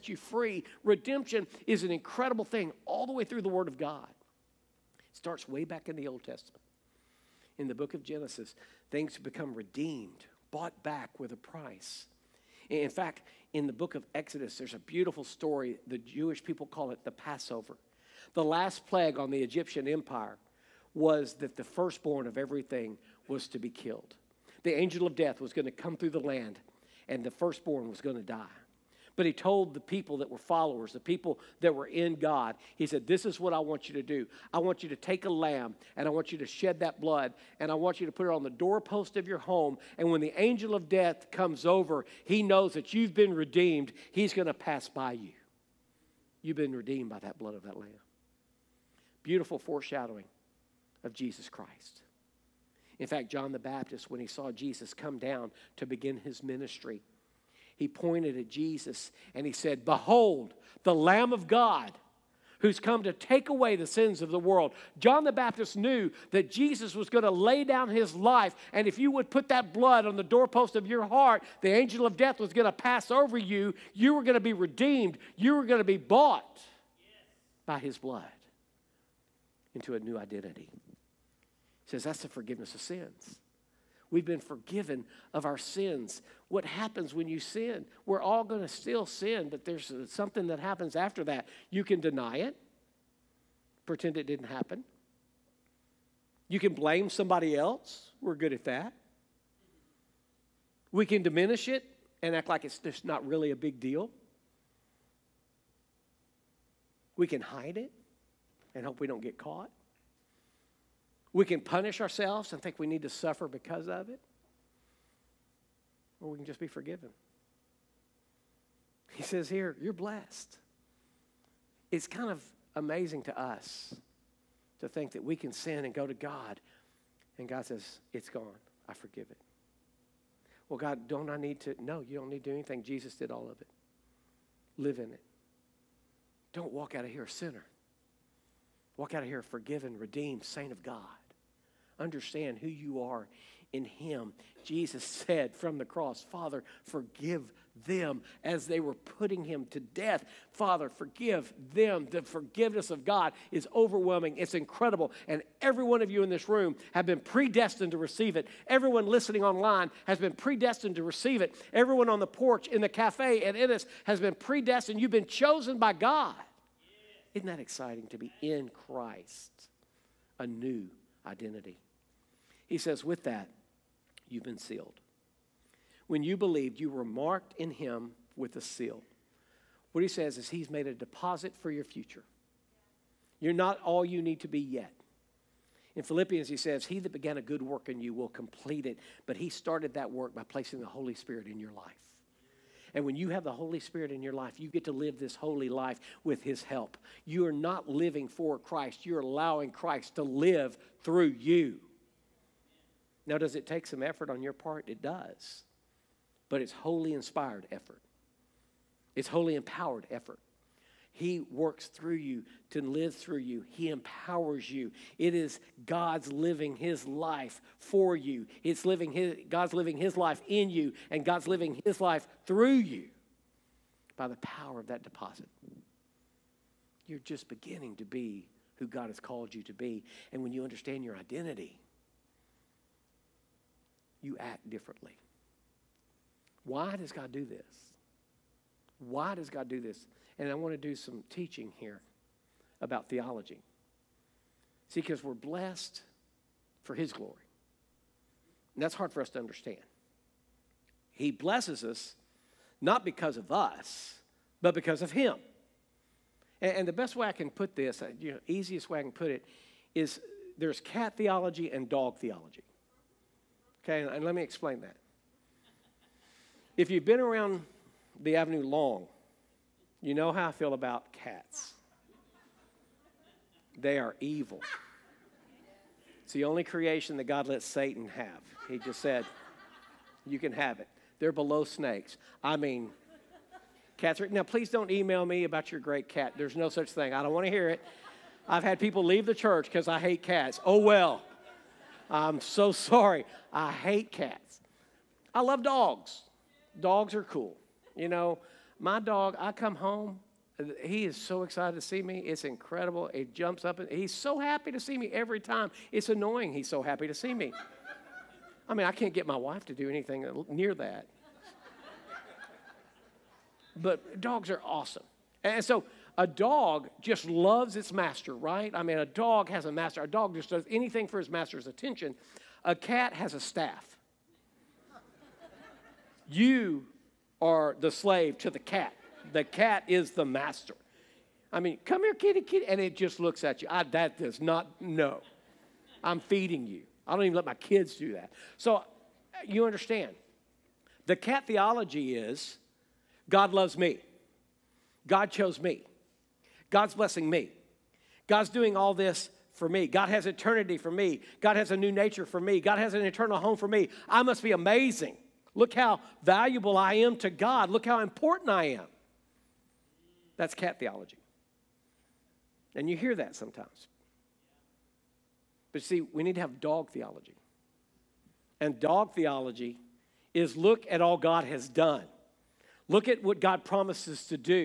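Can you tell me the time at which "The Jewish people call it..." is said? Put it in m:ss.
0:15.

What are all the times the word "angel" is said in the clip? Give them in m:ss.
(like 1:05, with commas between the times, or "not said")
0:24, 0:40, 1:11.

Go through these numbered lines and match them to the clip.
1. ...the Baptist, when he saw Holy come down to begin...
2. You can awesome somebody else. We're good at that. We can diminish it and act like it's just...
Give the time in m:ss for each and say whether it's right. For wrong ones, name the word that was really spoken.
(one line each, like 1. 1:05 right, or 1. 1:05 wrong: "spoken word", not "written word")
1. 0:53 wrong: "Jesus", not "Holy"
2. 1:36 wrong: "blame", not "awesome".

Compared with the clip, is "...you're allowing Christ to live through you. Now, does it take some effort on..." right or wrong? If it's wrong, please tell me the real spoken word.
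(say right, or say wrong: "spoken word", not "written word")
right.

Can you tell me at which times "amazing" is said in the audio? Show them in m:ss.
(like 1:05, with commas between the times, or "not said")
2:02, 5:54.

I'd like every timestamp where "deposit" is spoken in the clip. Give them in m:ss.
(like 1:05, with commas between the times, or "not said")
3:00, 3:45.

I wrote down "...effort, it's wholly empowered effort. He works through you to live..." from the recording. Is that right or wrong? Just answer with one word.
right.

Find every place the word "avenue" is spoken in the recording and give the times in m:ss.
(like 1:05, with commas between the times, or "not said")
4:28.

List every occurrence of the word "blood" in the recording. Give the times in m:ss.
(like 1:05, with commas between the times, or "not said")
0:37, 0:47, 1:09, 1:17.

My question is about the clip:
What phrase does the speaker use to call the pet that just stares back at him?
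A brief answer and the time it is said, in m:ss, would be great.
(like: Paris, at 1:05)
kitty, kitty, at 5:32.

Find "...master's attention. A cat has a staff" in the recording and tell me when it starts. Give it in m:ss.
5:21.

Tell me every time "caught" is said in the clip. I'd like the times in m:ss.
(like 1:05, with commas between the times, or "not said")
1:49.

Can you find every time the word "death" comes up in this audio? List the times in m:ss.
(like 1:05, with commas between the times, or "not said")
0:25, 0:40, 1:12, 2:29.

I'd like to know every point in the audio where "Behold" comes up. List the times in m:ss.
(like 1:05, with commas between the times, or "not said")
0:59.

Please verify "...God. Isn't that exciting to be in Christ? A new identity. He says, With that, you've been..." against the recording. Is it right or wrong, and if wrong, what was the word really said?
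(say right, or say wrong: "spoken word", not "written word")
right.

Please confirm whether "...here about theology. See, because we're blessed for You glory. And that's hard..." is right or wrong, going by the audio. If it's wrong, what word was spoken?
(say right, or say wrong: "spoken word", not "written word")
wrong: "His", not "You".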